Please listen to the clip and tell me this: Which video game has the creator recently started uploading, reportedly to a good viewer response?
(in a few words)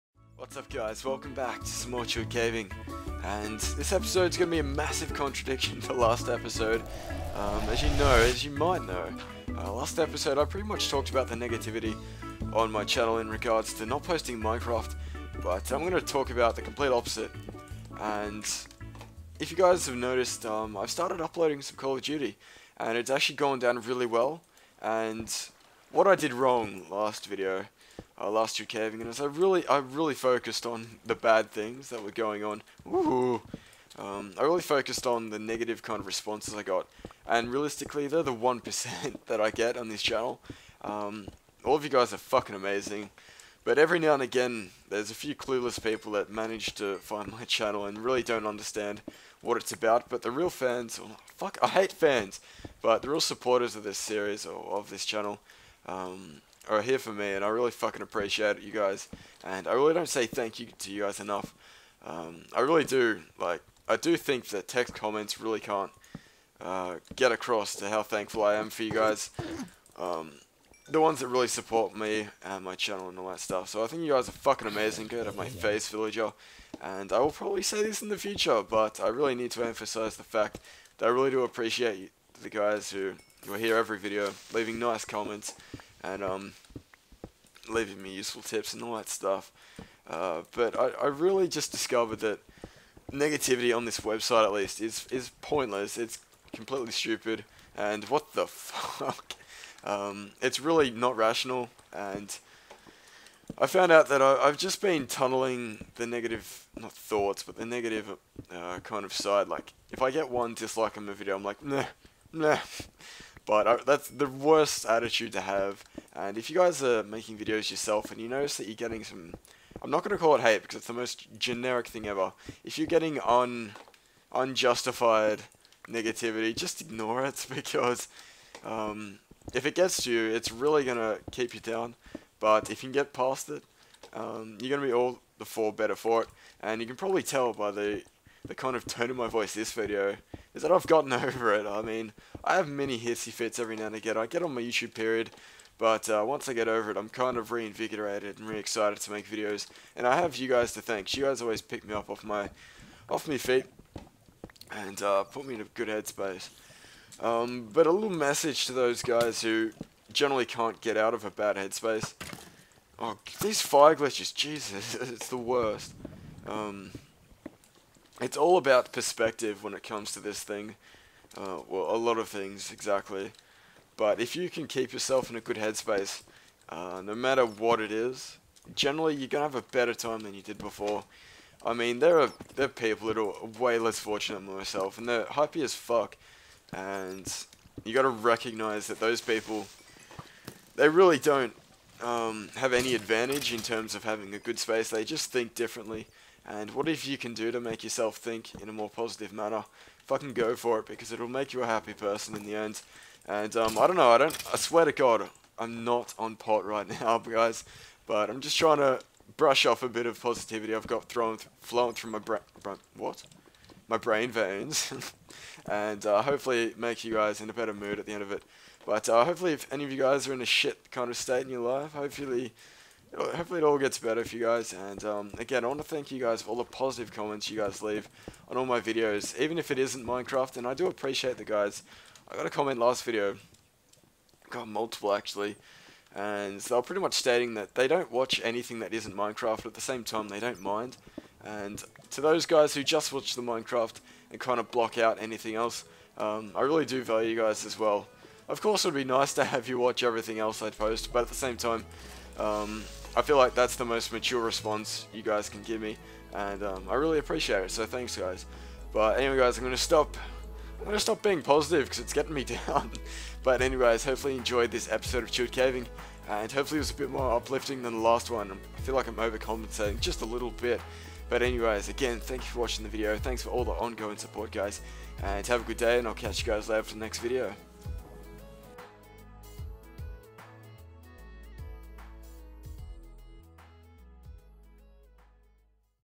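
Call of Duty.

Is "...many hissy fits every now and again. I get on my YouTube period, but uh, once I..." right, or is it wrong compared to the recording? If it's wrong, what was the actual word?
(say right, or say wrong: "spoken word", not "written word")
right.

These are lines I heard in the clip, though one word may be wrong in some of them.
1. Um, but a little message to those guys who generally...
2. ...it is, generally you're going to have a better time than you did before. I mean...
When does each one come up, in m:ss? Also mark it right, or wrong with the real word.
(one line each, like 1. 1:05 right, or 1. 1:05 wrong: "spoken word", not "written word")
1. 2:37 right
2. 2:57 right.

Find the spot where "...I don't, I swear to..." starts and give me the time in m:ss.
3:24.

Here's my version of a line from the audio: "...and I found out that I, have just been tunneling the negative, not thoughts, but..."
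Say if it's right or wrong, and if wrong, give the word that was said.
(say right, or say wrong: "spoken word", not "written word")
right.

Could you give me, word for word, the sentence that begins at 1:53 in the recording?
But uh, that's the worst attitude to have.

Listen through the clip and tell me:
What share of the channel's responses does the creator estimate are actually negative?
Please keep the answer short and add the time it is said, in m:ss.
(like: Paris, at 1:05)
1 percent, at 0:38.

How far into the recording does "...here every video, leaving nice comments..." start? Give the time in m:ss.
1:23.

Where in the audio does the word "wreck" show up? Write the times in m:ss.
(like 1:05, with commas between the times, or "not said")
not said.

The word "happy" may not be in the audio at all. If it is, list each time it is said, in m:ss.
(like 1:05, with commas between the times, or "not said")
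3:05, 3:21.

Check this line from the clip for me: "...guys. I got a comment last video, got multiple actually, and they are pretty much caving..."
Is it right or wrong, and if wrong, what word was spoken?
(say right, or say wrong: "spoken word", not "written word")
wrong: "stating", not "caving".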